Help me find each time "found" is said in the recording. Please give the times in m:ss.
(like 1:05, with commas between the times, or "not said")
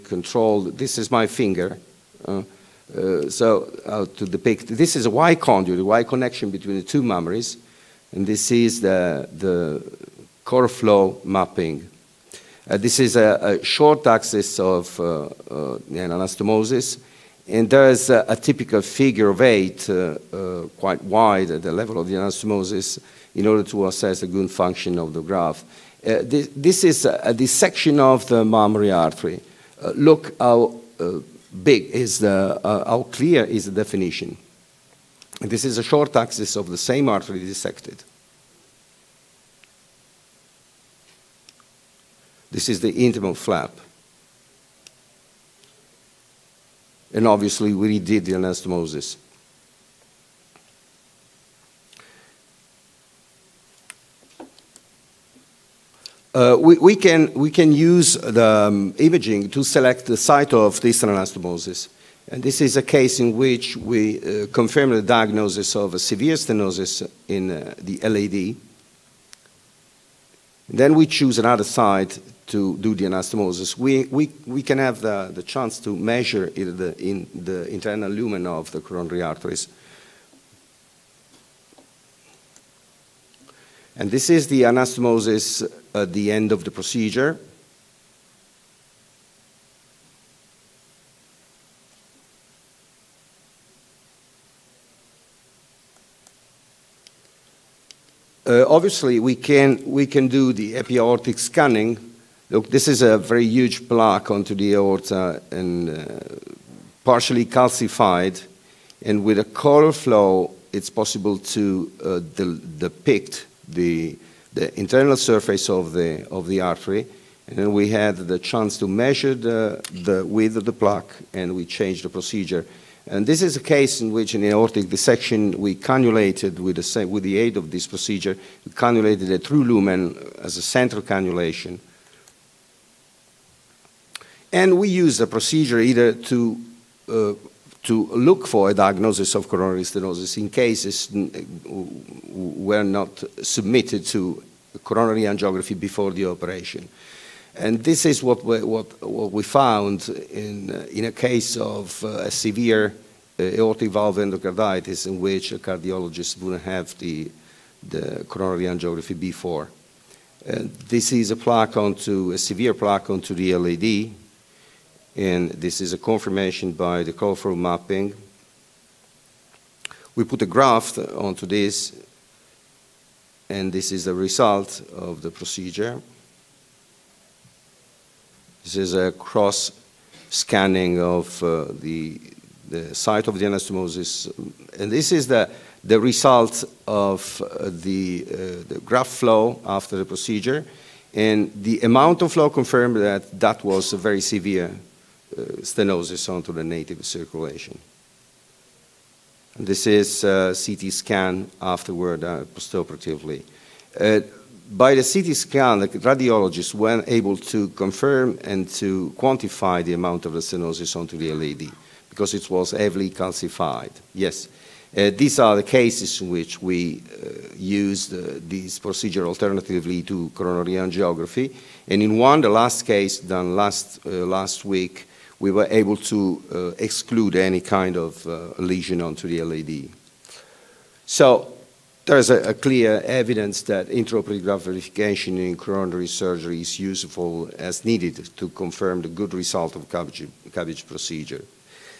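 2:29.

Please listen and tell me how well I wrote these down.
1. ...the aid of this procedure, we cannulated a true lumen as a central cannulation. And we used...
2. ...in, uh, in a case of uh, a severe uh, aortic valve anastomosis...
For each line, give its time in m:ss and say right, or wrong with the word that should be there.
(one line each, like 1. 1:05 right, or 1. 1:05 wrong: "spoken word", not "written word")
1. 2:07 right
2. 2:30 wrong: "endocarditis", not "anastomosis".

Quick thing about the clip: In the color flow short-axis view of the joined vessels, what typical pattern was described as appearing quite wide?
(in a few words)
Figure of eight.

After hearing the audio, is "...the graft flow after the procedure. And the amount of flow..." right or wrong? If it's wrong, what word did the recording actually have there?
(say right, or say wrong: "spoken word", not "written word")
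right.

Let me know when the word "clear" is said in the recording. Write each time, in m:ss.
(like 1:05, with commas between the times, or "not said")
0:33, 3:52.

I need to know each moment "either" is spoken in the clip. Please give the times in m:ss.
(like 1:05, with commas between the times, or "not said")
2:15.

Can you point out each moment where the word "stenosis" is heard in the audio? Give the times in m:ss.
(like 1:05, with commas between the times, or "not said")
1:06, 2:19, 3:15, 3:30.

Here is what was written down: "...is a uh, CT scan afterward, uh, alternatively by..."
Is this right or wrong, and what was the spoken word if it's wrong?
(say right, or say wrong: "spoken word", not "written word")
wrong: "postoperatively", not "alternatively".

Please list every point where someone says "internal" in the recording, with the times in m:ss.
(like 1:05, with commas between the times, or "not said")
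1:17, 1:54.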